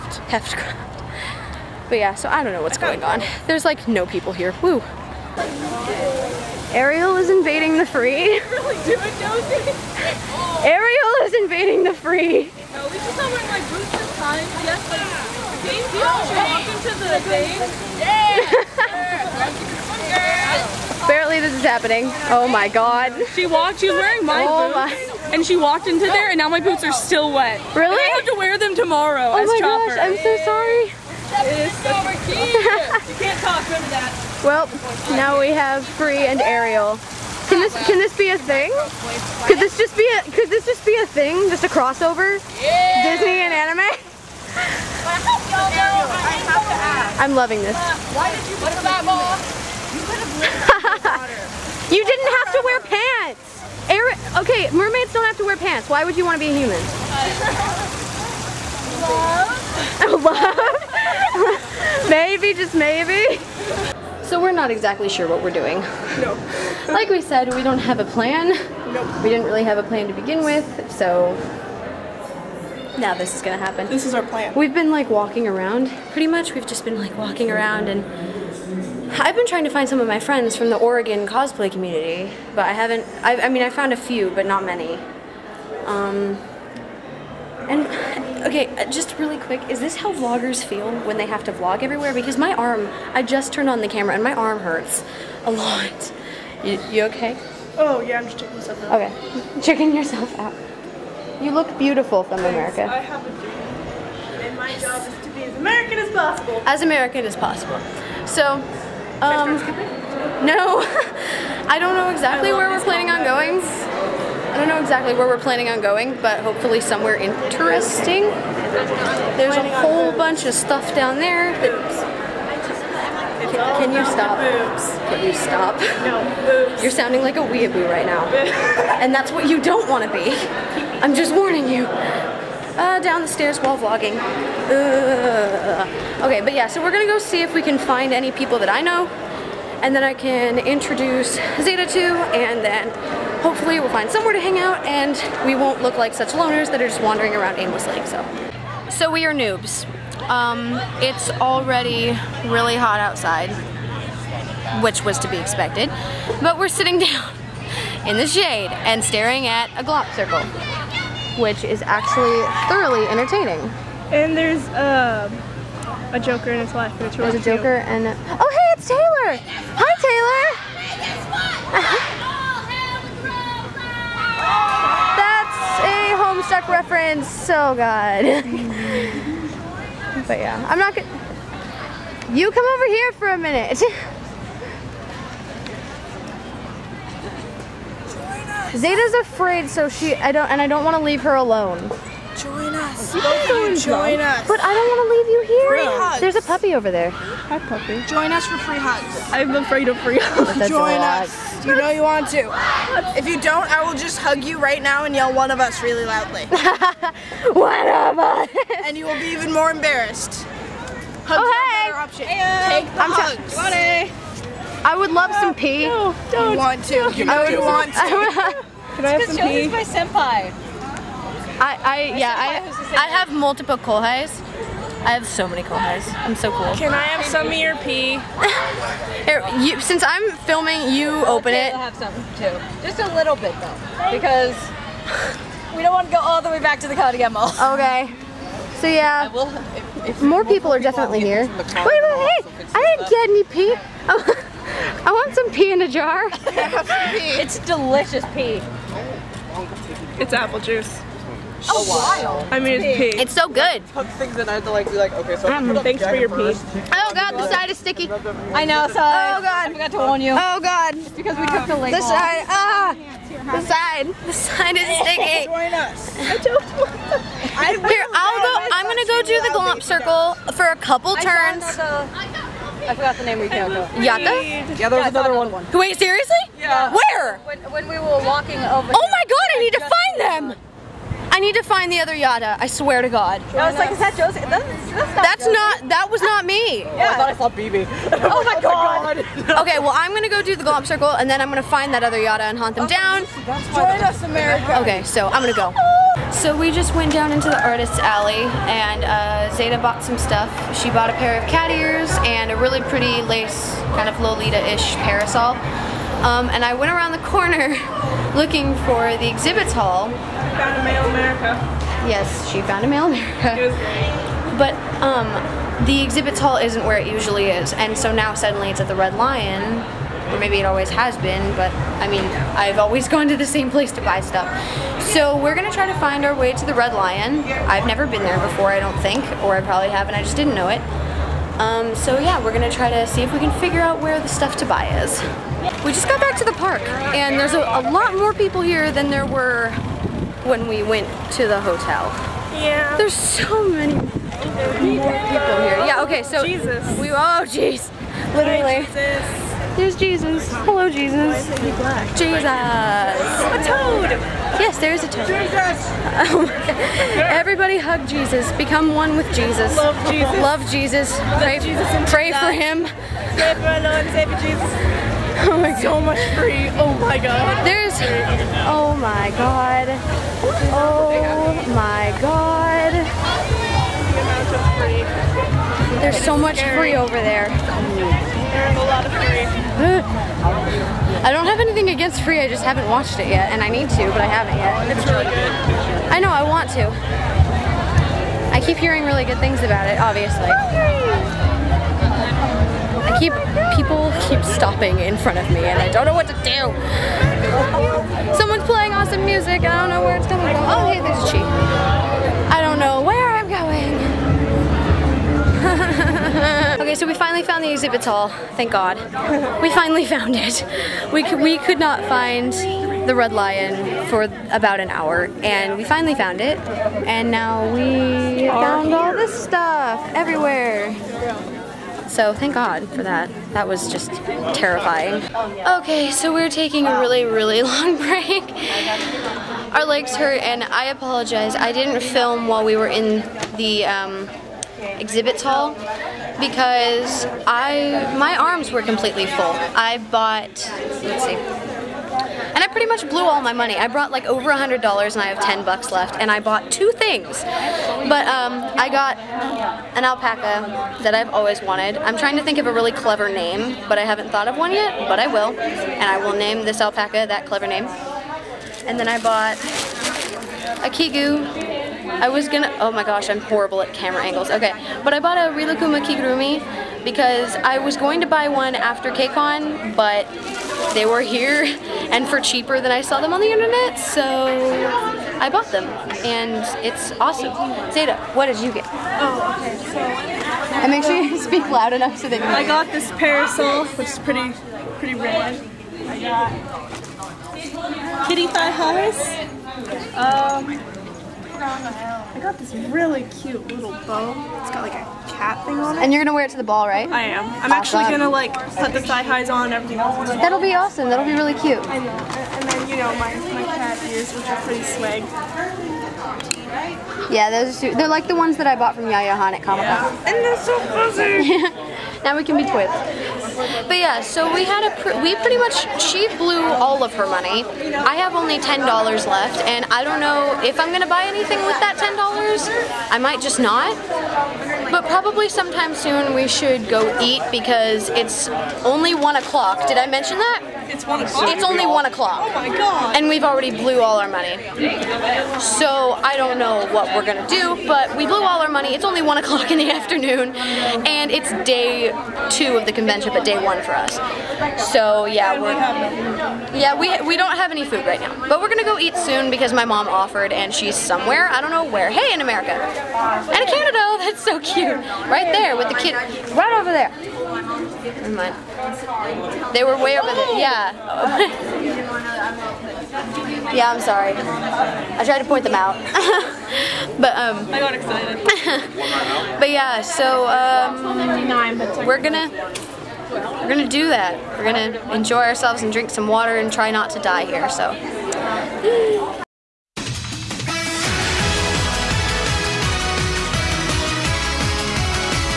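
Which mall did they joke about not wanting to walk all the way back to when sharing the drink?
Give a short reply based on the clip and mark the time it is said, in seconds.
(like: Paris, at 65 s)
Cardigan Mall, at 236 s.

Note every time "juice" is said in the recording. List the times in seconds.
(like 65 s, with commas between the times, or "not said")
250 s.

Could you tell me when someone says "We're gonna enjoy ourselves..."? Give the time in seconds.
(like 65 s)
574 s.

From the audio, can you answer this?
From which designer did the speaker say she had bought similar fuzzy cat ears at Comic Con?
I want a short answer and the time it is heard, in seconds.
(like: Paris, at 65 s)
Yaya Han, at 509 s.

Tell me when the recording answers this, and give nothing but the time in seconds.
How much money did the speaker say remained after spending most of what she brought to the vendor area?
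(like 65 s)
445 s.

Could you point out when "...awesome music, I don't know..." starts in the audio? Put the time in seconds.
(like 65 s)
398 s.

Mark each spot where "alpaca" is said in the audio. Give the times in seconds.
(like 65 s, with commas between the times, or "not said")
450 s, 456 s.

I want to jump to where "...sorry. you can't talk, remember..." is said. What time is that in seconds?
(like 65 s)
30 s.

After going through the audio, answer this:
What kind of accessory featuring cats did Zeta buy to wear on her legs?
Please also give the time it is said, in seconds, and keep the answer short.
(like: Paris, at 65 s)
Kitty Thigh Highs, at 488 s.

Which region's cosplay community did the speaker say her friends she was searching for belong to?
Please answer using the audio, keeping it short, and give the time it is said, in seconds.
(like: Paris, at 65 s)
Oregon, at 80 s.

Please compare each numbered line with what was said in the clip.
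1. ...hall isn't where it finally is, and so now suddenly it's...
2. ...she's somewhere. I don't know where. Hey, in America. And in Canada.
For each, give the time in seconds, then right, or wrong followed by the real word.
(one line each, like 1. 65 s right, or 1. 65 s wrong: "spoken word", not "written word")
1. 316 s wrong: "usually", not "finally"
2. 550 s right.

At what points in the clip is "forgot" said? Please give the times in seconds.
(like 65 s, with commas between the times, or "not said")
259 s, 272 s.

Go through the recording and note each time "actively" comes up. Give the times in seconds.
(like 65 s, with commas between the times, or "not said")
not said.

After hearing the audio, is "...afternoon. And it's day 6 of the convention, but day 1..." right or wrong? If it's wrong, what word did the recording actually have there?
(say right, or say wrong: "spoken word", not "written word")
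wrong: "2", not "6".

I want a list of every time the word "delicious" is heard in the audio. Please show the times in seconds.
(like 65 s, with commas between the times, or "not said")
247 s.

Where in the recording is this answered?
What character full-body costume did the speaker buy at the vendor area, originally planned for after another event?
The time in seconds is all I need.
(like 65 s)
465 s.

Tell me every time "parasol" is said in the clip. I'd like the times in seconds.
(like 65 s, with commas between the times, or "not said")
304 s, 483 s.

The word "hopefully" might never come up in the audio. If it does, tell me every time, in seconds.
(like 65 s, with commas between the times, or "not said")
116 s, 143 s.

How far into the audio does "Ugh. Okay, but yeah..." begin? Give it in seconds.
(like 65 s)
134 s.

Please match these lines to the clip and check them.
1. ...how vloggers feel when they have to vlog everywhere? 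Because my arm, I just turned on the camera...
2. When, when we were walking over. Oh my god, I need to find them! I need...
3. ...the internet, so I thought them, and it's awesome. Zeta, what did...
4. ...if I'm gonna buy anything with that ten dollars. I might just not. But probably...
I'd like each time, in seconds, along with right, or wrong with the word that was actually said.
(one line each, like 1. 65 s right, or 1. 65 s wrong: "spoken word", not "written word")
1. 89 s right
2. 277 s right
3. 473 s wrong: "bought", not "thought"
4. 520 s right.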